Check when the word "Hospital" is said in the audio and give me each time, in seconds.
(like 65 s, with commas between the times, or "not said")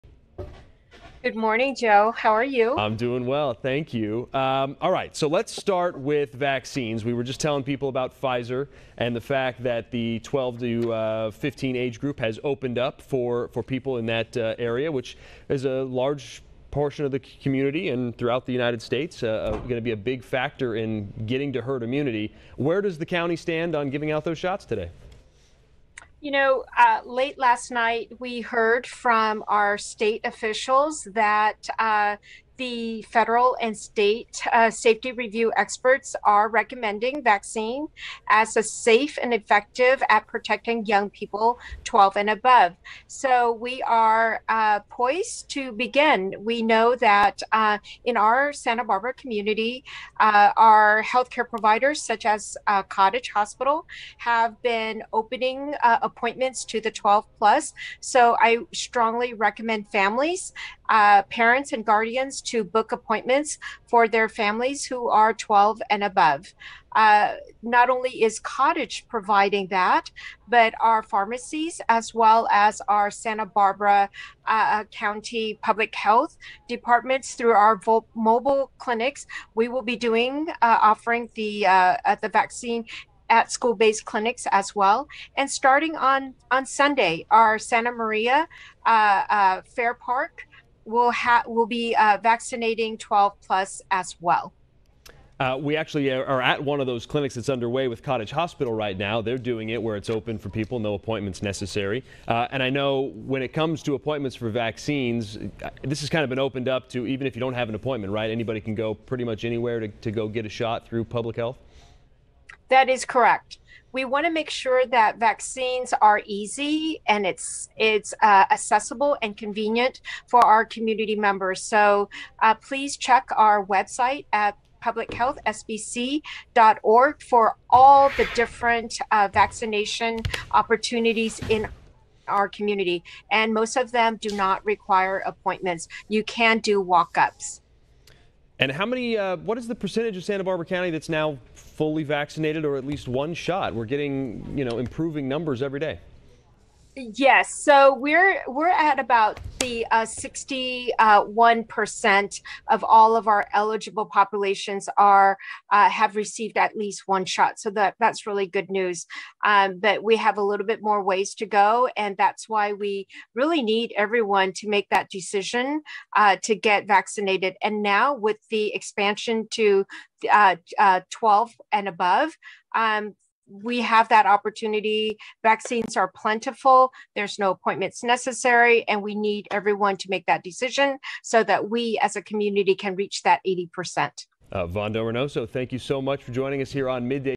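53 s, 98 s.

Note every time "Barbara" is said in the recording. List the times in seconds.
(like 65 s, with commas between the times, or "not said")
48 s, 73 s, 140 s.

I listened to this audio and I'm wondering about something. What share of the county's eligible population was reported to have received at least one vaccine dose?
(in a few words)
61%.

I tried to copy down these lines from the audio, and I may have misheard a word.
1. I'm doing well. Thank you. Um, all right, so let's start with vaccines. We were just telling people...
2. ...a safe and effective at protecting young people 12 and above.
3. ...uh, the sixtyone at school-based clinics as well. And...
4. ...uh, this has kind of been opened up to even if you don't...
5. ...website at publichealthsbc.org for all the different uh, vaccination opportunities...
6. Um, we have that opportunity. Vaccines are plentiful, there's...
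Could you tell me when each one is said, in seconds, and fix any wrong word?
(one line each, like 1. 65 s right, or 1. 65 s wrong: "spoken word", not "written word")
1. 2 s right
2. 38 s right
3. 82 s wrong: "vaccine", not "sixtyone"
4. 105 s right
5. 123 s right
6. 172 s right.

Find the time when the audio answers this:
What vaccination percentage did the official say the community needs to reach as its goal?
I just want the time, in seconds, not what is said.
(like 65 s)
183 s.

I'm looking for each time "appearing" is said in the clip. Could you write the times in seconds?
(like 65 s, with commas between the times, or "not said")
not said.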